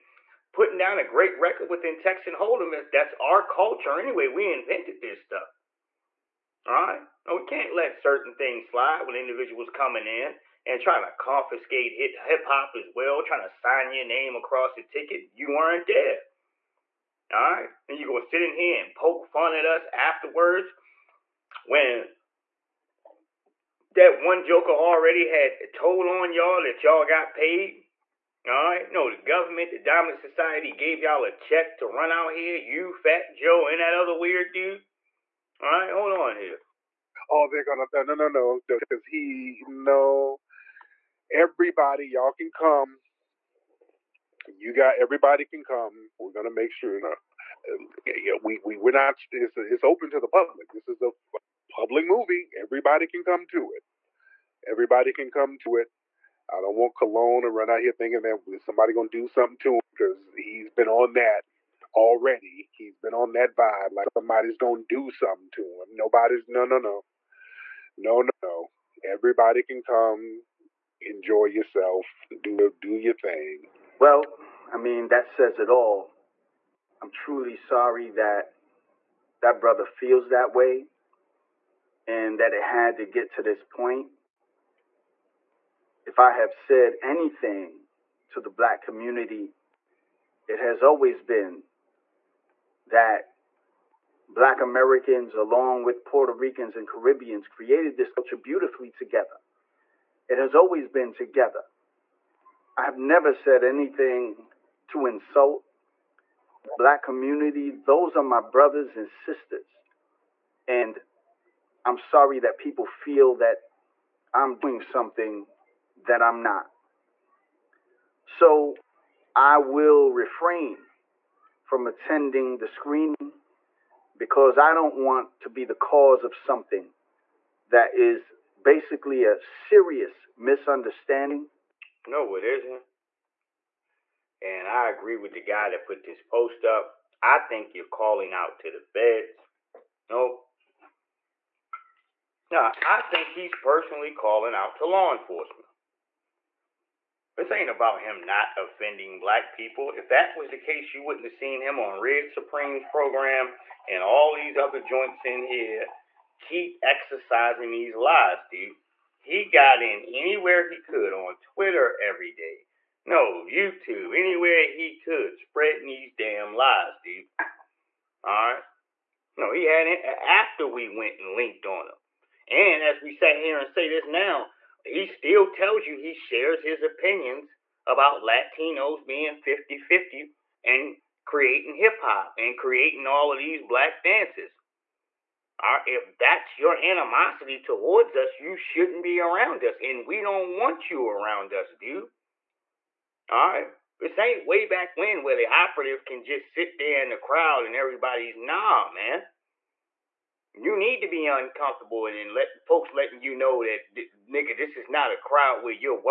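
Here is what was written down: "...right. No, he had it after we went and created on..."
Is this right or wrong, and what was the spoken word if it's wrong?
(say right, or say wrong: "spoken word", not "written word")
wrong: "linked", not "created".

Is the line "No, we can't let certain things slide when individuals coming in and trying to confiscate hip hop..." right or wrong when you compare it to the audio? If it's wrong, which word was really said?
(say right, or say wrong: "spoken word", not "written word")
right.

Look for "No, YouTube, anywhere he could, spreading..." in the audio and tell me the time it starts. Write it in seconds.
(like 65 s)
163 s.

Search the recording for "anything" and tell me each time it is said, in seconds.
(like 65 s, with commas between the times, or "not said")
87 s, 103 s.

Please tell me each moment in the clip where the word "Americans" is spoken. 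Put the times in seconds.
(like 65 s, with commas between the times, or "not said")
94 s.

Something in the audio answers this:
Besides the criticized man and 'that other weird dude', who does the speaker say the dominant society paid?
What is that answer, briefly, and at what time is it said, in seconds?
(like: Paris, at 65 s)
Fat Joe, at 32 s.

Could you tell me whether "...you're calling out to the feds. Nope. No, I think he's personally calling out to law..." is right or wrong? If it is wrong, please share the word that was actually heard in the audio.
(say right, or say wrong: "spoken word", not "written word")
right.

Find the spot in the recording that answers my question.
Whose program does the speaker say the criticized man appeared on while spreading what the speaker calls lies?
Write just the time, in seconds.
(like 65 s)
152 s.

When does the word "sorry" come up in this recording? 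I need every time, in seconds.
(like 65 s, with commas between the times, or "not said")
77 s, 111 s.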